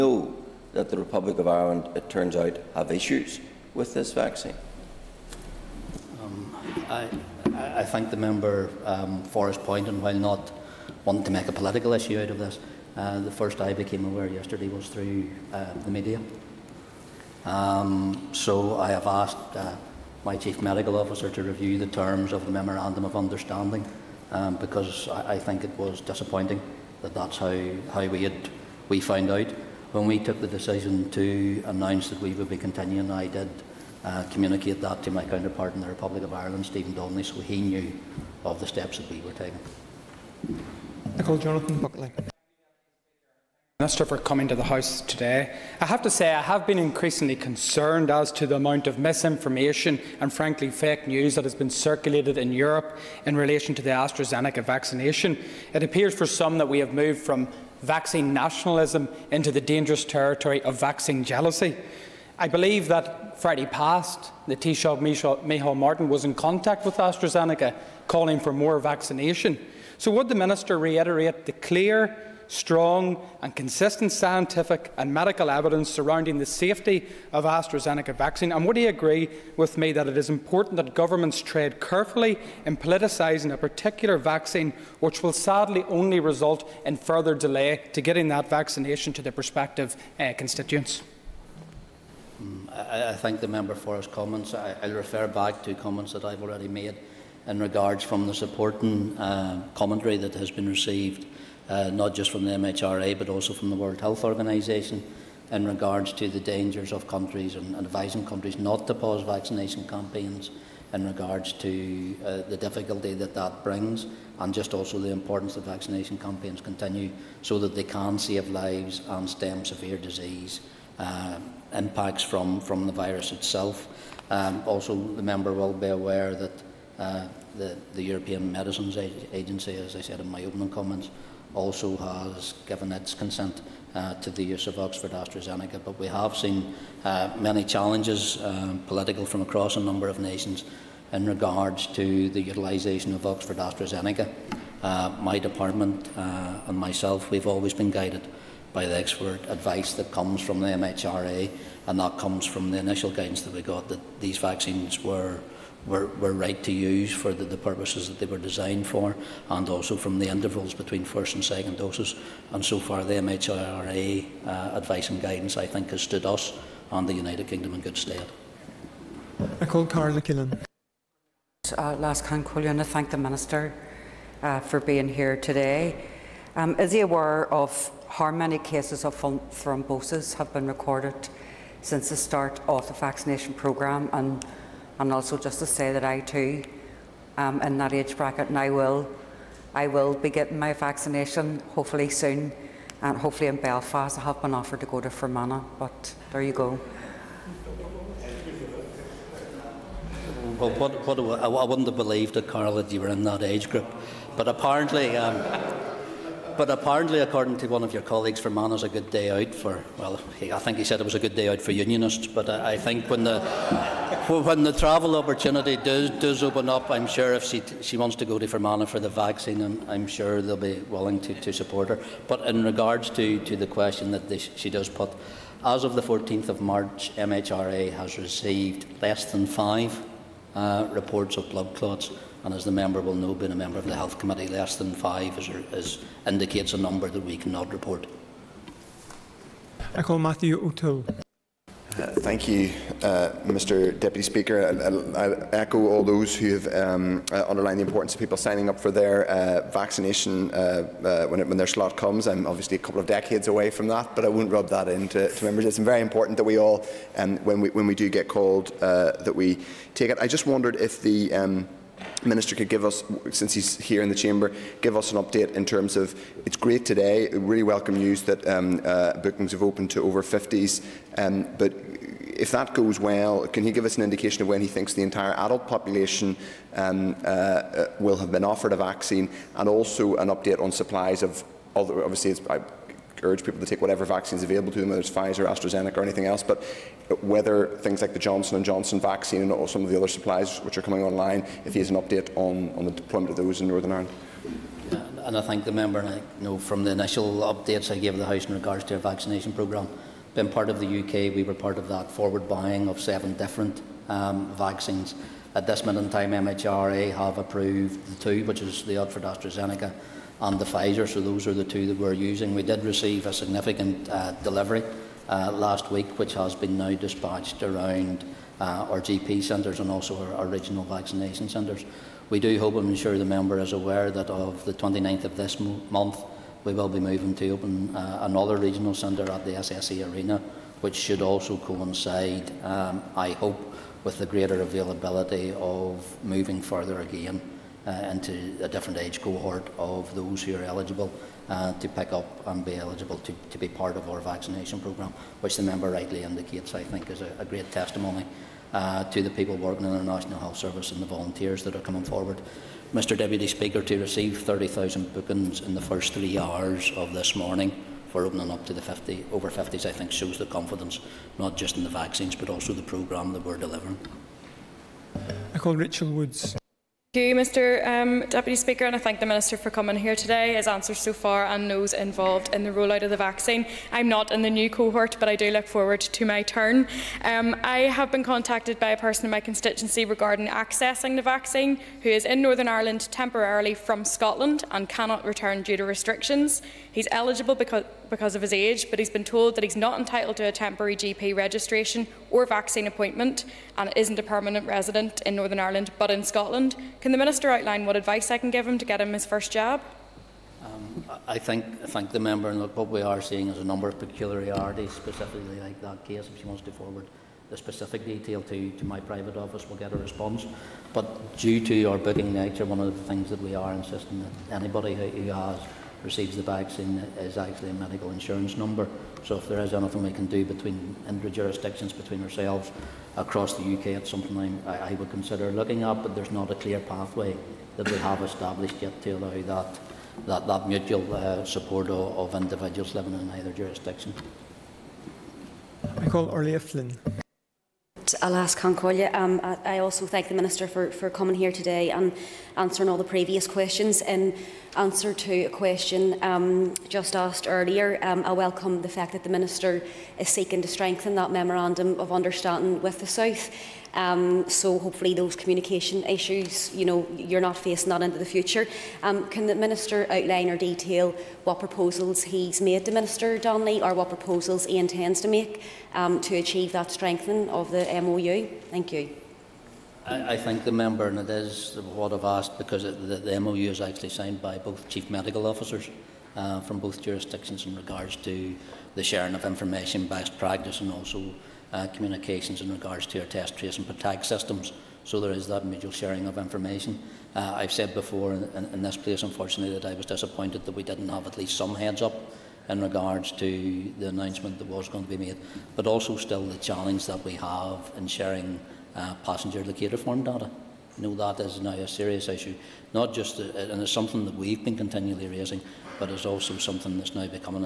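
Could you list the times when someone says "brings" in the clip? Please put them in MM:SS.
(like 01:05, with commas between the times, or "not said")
01:53.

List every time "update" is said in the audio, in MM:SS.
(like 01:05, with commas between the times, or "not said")
04:25, 04:40, 04:51, 04:57.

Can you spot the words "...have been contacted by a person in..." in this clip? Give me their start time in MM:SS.
06:17.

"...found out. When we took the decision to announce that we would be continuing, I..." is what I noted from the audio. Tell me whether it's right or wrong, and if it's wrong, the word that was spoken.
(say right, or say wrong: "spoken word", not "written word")
right.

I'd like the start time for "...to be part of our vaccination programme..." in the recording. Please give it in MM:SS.
05:43.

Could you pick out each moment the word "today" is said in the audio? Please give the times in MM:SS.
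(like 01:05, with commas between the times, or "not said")
00:45, 02:55, 04:26, 06:10, 07:21.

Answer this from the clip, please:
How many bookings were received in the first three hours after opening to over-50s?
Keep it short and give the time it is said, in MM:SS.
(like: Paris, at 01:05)
30,000, at 05:54.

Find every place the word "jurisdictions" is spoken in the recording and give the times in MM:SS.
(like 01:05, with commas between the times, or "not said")
07:01, 07:13, 07:57.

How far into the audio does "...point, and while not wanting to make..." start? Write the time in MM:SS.
00:09.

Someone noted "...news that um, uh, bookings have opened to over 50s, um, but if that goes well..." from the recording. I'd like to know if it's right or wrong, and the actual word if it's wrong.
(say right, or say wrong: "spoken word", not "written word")
right.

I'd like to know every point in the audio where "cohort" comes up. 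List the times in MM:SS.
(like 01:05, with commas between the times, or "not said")
05:39, 06:14.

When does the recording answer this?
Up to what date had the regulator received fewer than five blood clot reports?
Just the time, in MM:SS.
03:46.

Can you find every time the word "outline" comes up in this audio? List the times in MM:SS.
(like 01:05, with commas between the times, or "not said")
06:37, 07:40.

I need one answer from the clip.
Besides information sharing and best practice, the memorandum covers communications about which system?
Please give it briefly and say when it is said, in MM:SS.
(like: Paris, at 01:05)
test, trace, and protect, at 08:03.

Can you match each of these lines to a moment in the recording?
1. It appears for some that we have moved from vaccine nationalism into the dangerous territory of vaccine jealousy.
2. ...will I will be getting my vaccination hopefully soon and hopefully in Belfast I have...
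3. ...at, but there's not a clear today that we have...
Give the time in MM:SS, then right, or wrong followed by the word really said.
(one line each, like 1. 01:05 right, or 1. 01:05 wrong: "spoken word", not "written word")
1. 00:55 right
2. 03:08 right
3. 07:05 wrong: "pathway", not "today".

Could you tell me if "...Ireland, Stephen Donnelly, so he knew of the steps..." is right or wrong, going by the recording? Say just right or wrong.
right.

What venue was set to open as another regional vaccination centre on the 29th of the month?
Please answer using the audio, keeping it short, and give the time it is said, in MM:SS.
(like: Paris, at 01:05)
SSE Arena, at 05:29.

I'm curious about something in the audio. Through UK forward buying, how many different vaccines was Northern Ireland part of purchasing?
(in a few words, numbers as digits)
7.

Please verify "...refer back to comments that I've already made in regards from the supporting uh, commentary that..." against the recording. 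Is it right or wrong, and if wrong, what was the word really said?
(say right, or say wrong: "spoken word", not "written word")
right.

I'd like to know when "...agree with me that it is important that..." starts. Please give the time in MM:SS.
01:18.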